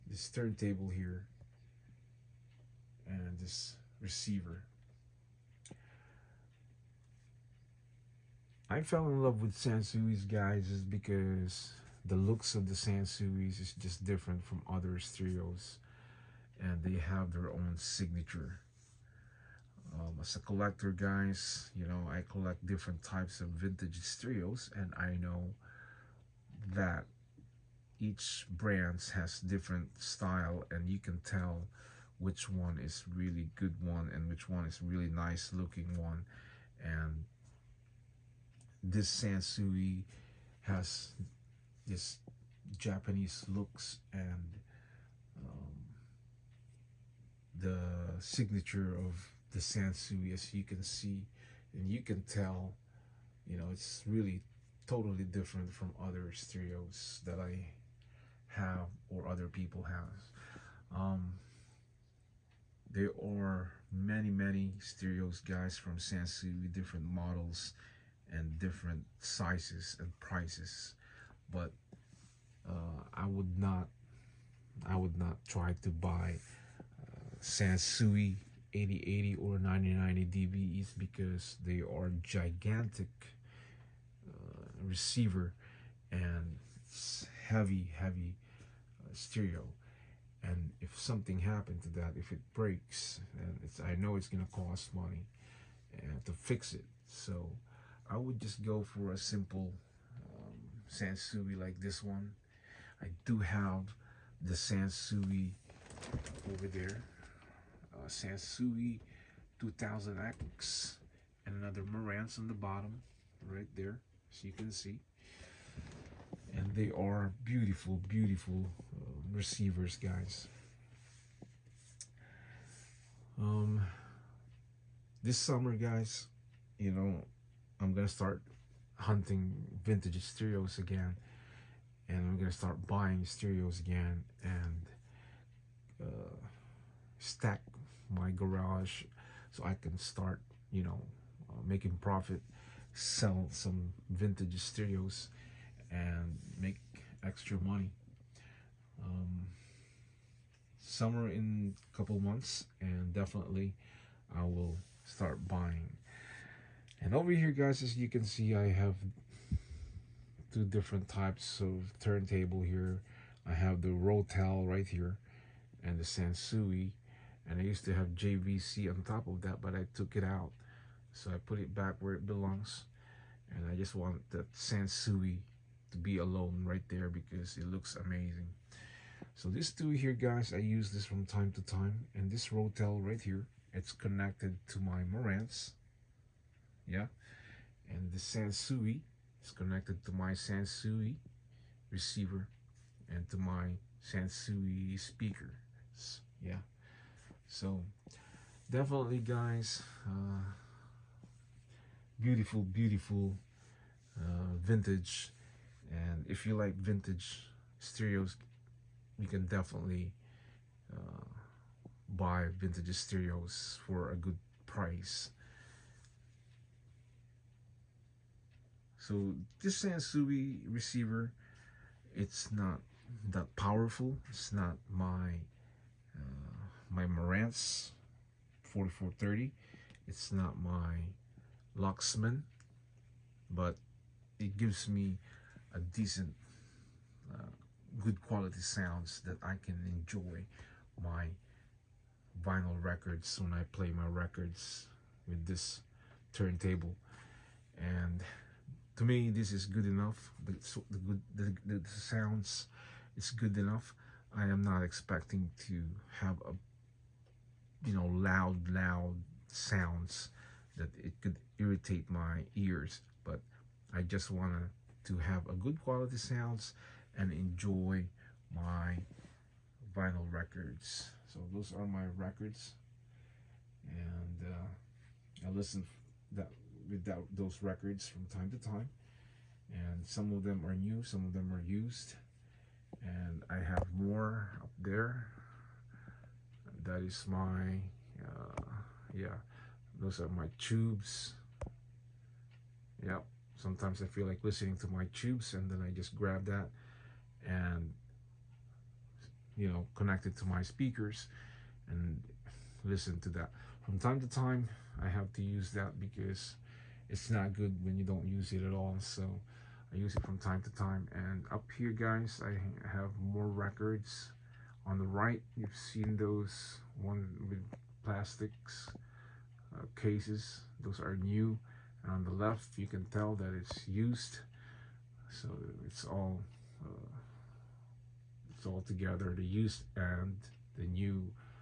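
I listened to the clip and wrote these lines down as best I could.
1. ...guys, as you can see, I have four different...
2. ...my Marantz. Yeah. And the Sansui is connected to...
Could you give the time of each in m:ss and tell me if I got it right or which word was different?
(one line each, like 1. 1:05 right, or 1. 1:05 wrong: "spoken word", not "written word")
1. 2:37 wrong: "two", not "four"
2. 3:04 right.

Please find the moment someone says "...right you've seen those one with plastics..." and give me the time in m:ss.
5:15.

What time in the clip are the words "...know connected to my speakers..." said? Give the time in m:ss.
4:59.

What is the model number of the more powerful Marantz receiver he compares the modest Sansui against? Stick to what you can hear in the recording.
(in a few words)
4430.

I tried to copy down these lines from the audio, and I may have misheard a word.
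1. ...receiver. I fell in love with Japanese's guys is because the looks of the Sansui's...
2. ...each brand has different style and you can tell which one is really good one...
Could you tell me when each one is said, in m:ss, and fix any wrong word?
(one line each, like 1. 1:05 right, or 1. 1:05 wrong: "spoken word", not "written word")
1. 0:04 wrong: "Sansui", not "Japanese"
2. 0:28 right.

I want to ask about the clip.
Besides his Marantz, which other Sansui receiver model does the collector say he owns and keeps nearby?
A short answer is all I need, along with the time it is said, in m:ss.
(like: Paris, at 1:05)
Sansui 2000X, at 1:48.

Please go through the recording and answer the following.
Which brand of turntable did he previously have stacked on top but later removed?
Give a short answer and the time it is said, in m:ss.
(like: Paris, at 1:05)
JVC, at 2:48.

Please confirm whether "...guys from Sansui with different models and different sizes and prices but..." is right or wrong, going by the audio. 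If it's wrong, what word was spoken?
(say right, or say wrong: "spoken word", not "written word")
right.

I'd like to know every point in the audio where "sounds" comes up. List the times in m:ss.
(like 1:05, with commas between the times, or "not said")
3:58, 4:11, 4:19, 4:26.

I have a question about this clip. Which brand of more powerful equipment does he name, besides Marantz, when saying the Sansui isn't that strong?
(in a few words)
Luxman.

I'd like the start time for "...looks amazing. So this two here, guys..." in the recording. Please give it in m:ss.
2:57.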